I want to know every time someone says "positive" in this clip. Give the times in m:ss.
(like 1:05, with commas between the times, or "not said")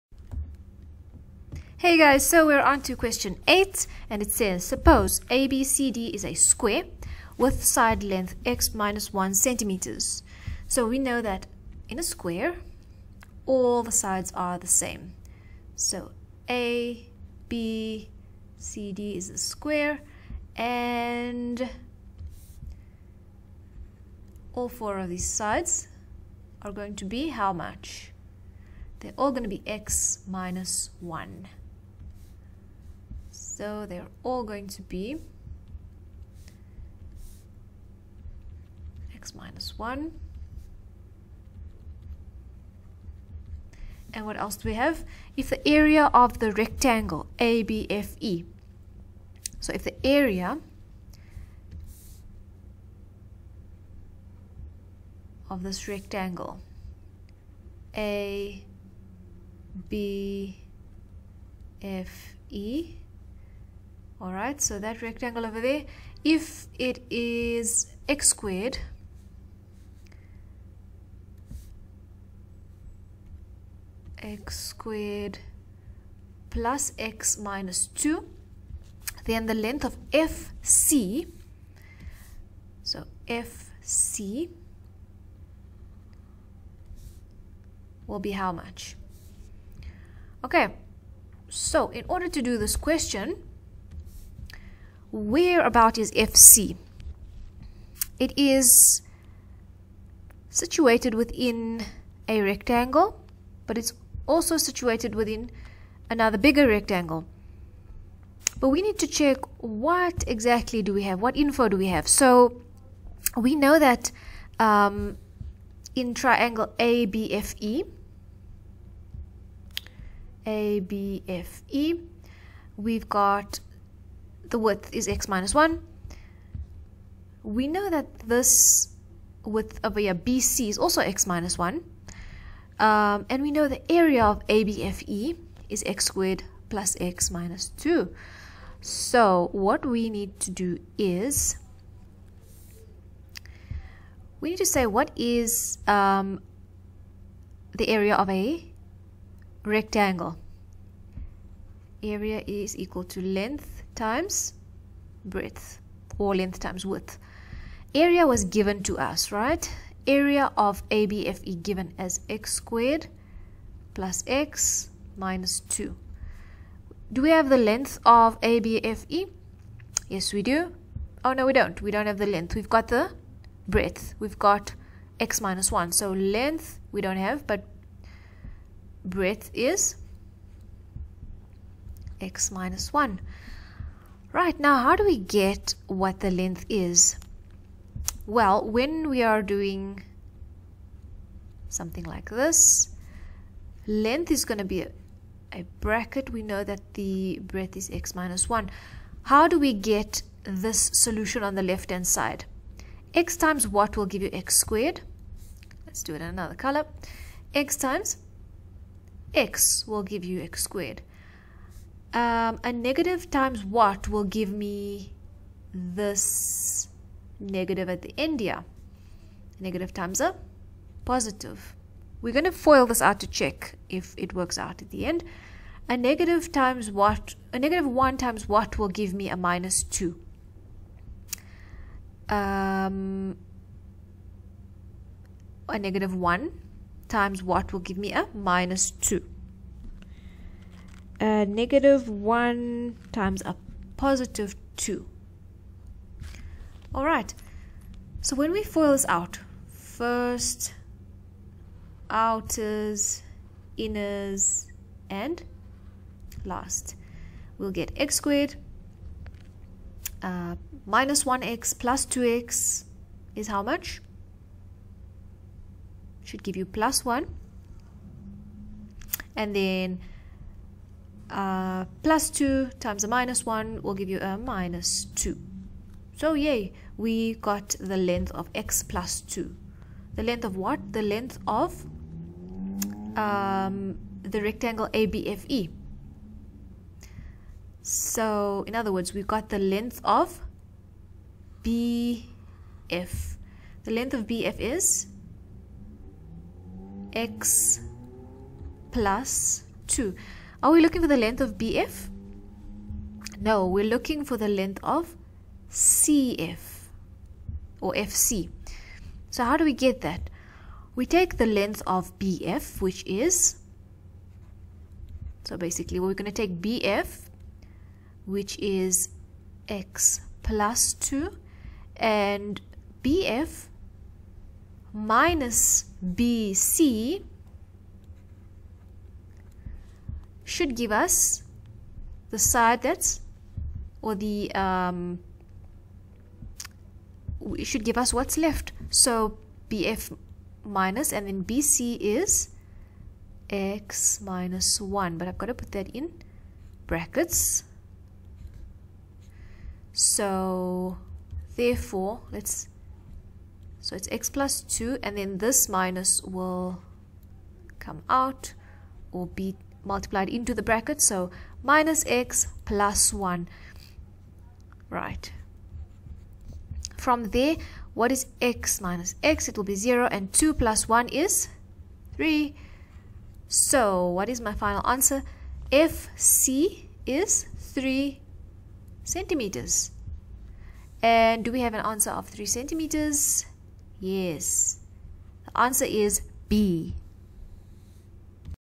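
3:41, 4:03.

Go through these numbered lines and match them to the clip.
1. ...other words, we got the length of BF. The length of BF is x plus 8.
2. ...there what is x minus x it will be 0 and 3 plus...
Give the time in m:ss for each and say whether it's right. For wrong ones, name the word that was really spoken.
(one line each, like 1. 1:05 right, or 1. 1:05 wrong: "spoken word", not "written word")
1. 4:48 wrong: "2", not "8"
2. 6:07 wrong: "2", not "3".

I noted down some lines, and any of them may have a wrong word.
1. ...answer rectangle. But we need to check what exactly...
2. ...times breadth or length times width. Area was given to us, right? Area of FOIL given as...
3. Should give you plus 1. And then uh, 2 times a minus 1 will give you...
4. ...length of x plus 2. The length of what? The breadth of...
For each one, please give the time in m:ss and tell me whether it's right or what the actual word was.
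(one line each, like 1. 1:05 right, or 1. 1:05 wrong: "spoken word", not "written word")
1. 1:46 wrong: "bigger", not "answer"
2. 2:34 wrong: "ABFE", not "FOIL"
3. 4:26 right
4. 4:37 wrong: "length", not "breadth".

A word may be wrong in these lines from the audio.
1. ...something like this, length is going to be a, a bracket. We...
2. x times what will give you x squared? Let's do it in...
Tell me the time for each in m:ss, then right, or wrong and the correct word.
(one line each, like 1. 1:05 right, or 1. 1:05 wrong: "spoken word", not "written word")
1. 3:11 right
2. 3:23 right.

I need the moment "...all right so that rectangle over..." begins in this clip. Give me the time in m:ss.
1:04.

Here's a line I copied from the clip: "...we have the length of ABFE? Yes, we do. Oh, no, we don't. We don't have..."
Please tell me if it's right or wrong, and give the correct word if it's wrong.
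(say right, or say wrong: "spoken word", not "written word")
right.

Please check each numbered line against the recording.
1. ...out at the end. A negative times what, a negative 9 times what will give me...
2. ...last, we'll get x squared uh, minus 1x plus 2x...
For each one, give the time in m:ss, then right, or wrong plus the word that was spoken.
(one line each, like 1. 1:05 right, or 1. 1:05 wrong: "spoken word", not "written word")
1. 3:44 wrong: "1", not "9"
2. 4:16 right.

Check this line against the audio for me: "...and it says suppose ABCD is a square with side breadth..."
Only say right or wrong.
wrong.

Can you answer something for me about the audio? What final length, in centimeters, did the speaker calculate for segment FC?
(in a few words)
3 centimeters.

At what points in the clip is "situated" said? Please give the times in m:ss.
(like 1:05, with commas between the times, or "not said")
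1:40, 1:44.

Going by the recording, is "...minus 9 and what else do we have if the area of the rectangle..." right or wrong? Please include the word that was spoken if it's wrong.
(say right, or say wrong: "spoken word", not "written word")
wrong: "1", not "9".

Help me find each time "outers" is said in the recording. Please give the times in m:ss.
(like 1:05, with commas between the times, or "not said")
4:12.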